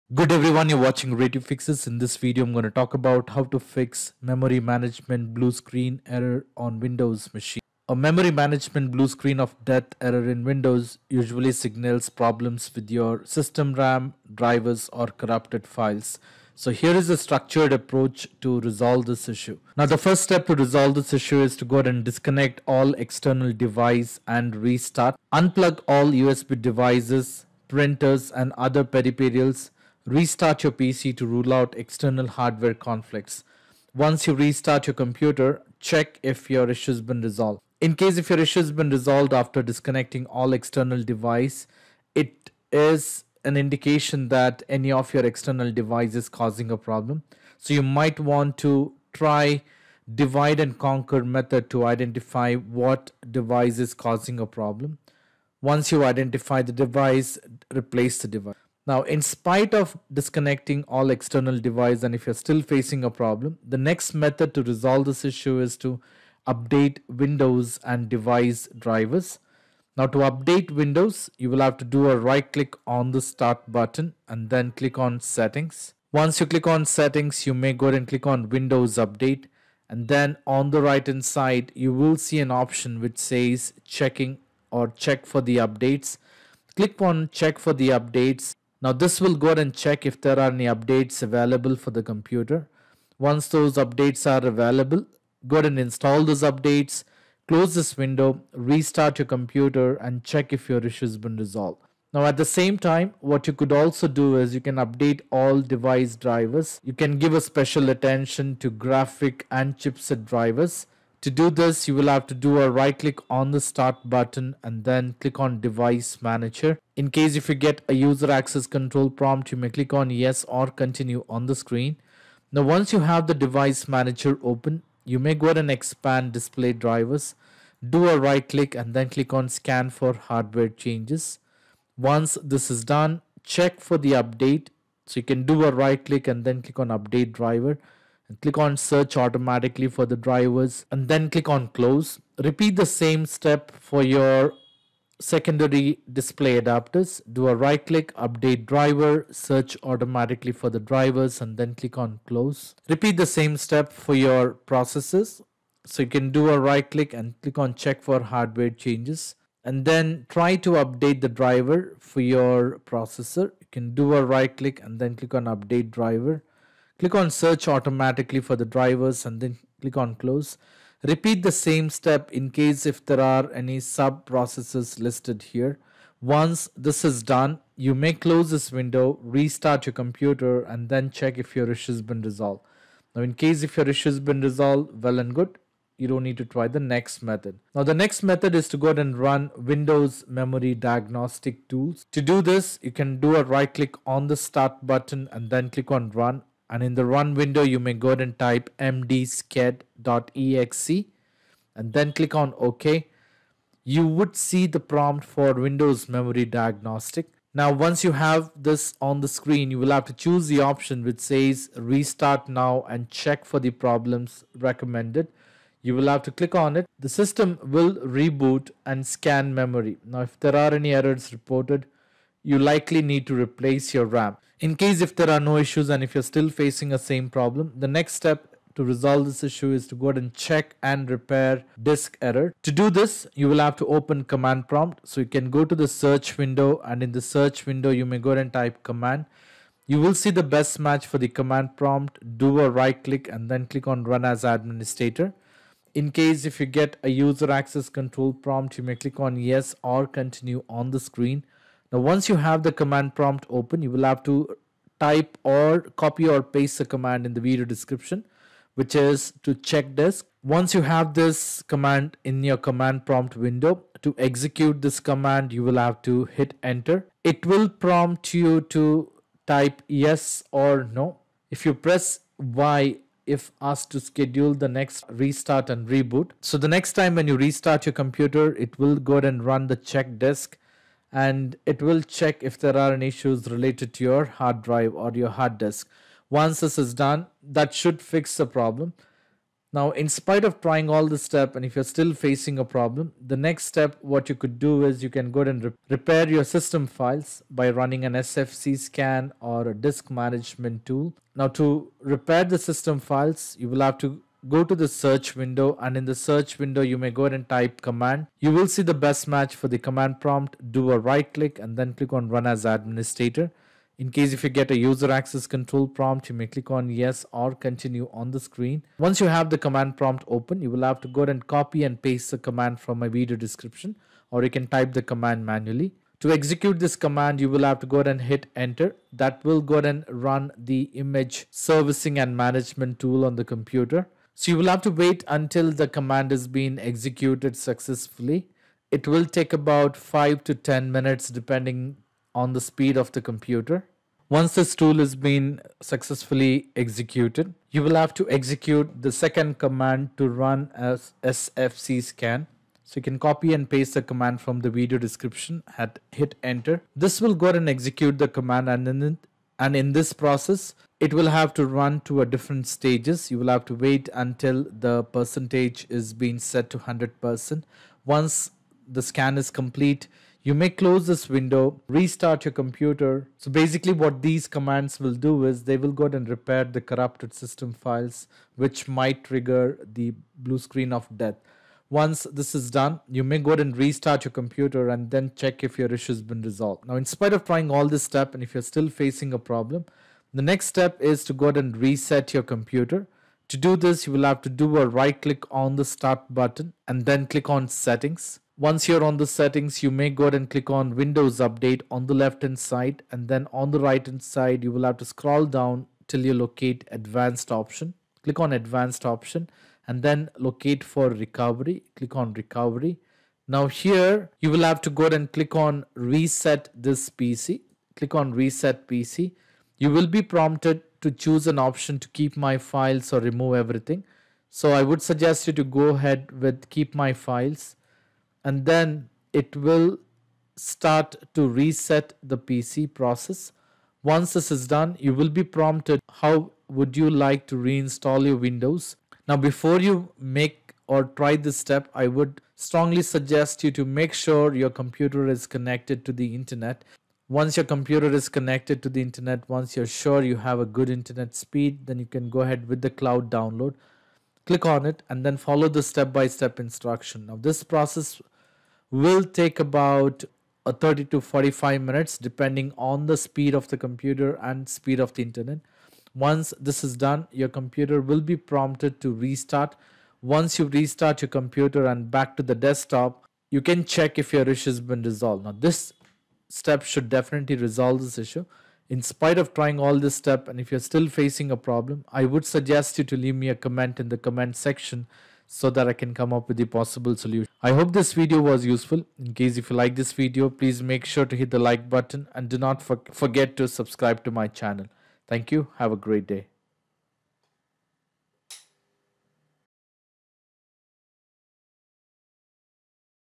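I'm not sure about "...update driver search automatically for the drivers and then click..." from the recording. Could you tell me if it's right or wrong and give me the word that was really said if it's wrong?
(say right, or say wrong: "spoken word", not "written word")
right.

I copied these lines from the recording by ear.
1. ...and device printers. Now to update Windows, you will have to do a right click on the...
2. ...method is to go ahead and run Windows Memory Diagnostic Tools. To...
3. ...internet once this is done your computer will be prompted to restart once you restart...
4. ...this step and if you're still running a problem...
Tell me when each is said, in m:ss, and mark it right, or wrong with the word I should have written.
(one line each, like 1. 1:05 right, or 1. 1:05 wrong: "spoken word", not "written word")
1. 1:07 wrong: "drivers", not "printers"
2. 3:08 right
3. 7:45 right
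4. 7:59 wrong: "facing", not "running".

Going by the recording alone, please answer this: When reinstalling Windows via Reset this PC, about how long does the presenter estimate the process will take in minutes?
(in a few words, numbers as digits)
30 to 45.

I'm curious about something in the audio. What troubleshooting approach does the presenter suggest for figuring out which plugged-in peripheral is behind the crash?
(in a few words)
divide and conquer.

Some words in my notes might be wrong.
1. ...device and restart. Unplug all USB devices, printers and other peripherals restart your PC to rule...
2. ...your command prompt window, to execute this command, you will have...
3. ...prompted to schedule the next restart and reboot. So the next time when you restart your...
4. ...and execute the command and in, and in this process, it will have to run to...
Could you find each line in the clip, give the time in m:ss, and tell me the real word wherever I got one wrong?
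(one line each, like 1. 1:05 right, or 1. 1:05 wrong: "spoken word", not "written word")
1. 0:23 right
2. 4:22 right
3. 4:33 wrong: "asked", not "prompted"
4. 5:57 right.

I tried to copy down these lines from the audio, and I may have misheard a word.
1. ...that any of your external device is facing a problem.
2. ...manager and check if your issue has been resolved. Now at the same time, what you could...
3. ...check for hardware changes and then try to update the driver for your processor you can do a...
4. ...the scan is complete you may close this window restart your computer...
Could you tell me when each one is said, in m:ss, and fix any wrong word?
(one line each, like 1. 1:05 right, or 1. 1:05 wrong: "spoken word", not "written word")
1. 0:44 wrong: "causing", not "facing"
2. 1:39 wrong: "computer", not "manager"
3. 2:37 right
4. 6:08 right.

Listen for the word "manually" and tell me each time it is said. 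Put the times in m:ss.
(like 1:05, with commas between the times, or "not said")
5:25.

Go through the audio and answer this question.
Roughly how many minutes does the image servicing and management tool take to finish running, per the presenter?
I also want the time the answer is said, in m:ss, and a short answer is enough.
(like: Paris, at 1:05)
5 to 10, at 5:39.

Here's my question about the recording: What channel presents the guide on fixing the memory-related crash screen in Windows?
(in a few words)
Ray Tube Fixes.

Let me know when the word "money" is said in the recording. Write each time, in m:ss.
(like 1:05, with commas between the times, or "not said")
not said.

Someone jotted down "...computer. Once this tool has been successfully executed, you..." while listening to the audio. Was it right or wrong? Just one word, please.
right.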